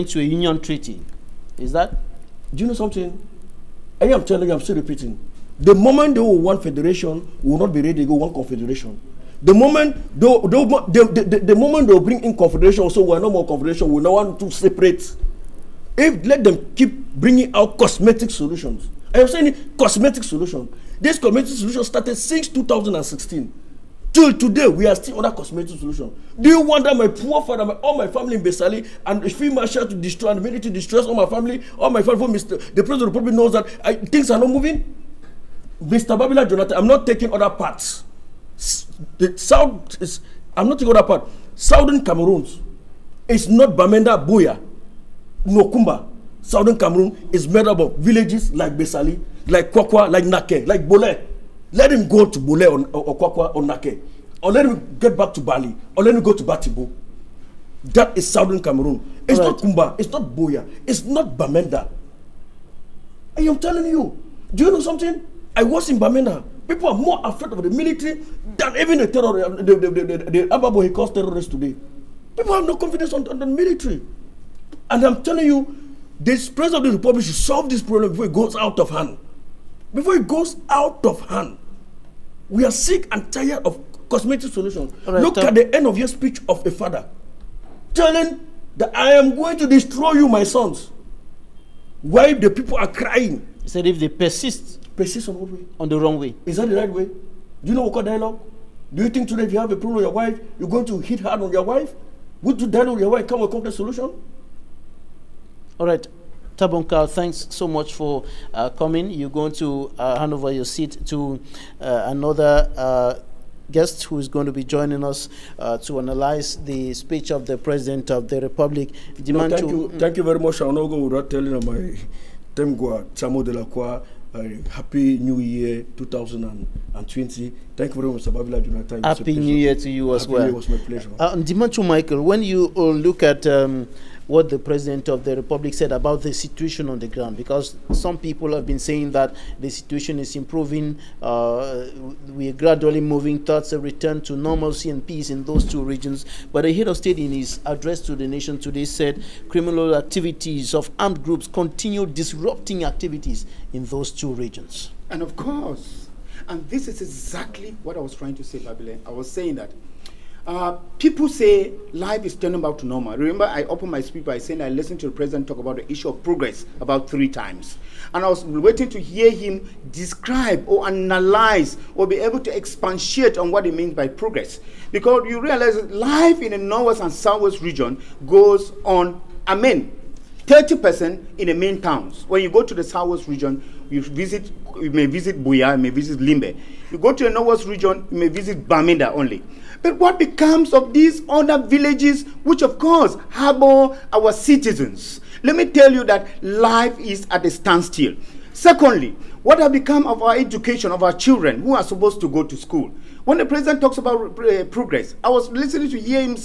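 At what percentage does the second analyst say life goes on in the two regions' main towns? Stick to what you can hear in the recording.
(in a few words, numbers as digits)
30%.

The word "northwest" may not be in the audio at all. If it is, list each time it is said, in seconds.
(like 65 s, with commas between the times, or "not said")
176 s, 187 s.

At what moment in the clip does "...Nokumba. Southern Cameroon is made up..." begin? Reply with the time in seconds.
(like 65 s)
45 s.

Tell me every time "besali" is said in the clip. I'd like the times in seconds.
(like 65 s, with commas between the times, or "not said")
28 s, 48 s.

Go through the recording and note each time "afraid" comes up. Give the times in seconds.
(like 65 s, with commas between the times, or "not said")
67 s.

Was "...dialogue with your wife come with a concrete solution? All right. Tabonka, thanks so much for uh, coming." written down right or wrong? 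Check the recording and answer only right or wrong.
right.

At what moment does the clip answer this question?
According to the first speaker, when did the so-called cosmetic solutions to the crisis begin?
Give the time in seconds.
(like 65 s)
22 s.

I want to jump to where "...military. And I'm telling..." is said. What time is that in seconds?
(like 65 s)
73 s.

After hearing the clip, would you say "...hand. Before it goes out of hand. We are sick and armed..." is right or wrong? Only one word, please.
wrong.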